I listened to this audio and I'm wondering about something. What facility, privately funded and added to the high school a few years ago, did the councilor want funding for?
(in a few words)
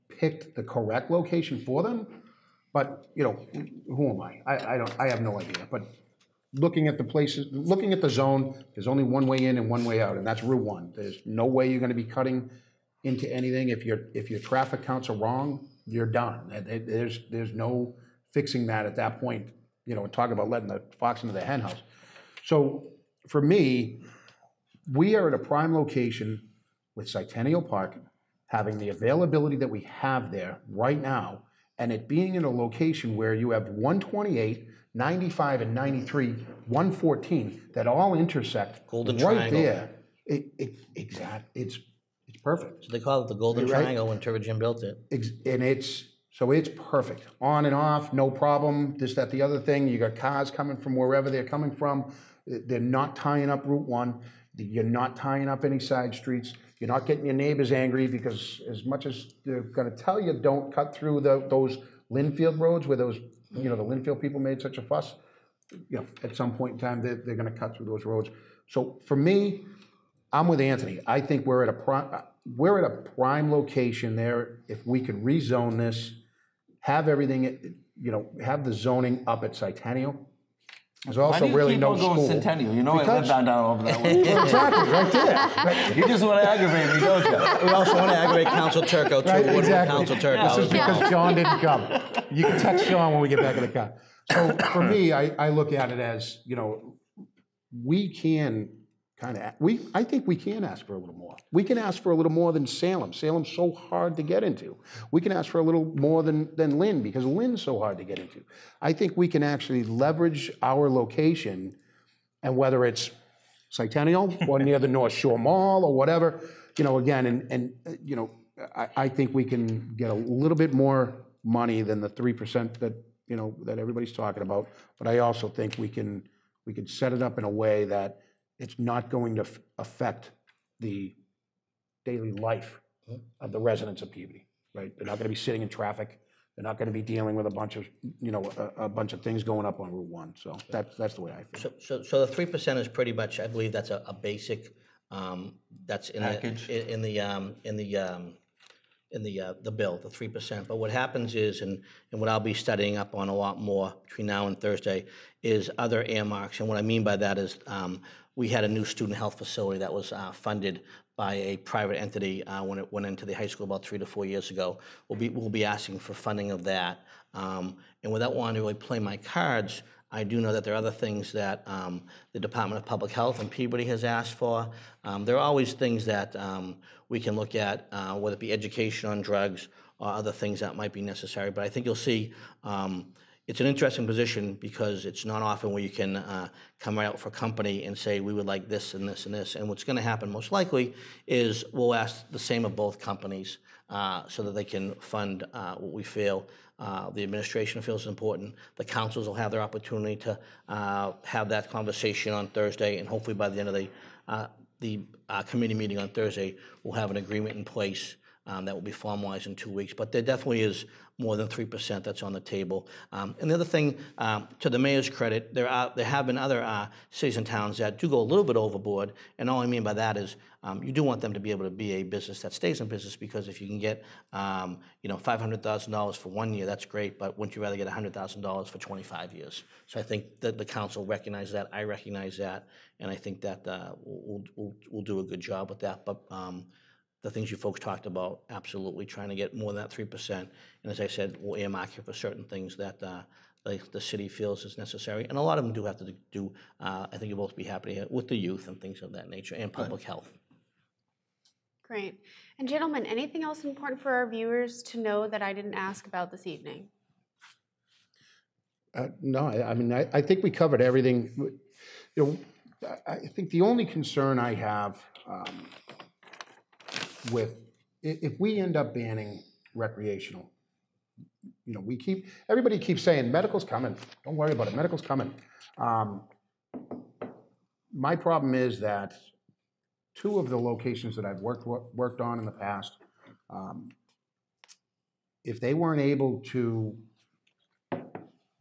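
Student health facility.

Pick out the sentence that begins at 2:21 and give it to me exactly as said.
So, so, so the three percent is pretty much, I believe, that's a, a basic.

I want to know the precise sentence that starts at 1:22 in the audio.
Centennial, you know because, I live down, down over that way.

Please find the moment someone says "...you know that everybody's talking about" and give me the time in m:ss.
2:03.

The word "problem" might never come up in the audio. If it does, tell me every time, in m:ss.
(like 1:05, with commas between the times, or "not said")
0:48, 4:38.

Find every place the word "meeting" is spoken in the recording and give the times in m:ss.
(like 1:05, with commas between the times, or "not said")
3:25.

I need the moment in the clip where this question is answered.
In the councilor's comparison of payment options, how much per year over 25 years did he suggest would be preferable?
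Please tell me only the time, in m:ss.
3:47.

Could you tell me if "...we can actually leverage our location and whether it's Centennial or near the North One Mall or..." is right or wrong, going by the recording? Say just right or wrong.
wrong.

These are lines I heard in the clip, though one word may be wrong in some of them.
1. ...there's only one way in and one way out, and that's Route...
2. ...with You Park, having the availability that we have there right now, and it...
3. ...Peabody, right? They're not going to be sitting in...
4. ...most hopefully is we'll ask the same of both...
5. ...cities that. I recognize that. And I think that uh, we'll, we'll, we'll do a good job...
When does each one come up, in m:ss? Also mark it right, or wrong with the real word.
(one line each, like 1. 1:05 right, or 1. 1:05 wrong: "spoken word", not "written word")
1. 0:08 right
2. 0:26 wrong: "Centennial", not "You"
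3. 2:14 right
4. 3:10 wrong: "likely", not "hopefully"
5. 3:51 wrong: "recognizes", not "cities".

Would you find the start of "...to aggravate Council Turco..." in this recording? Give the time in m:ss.
1:28.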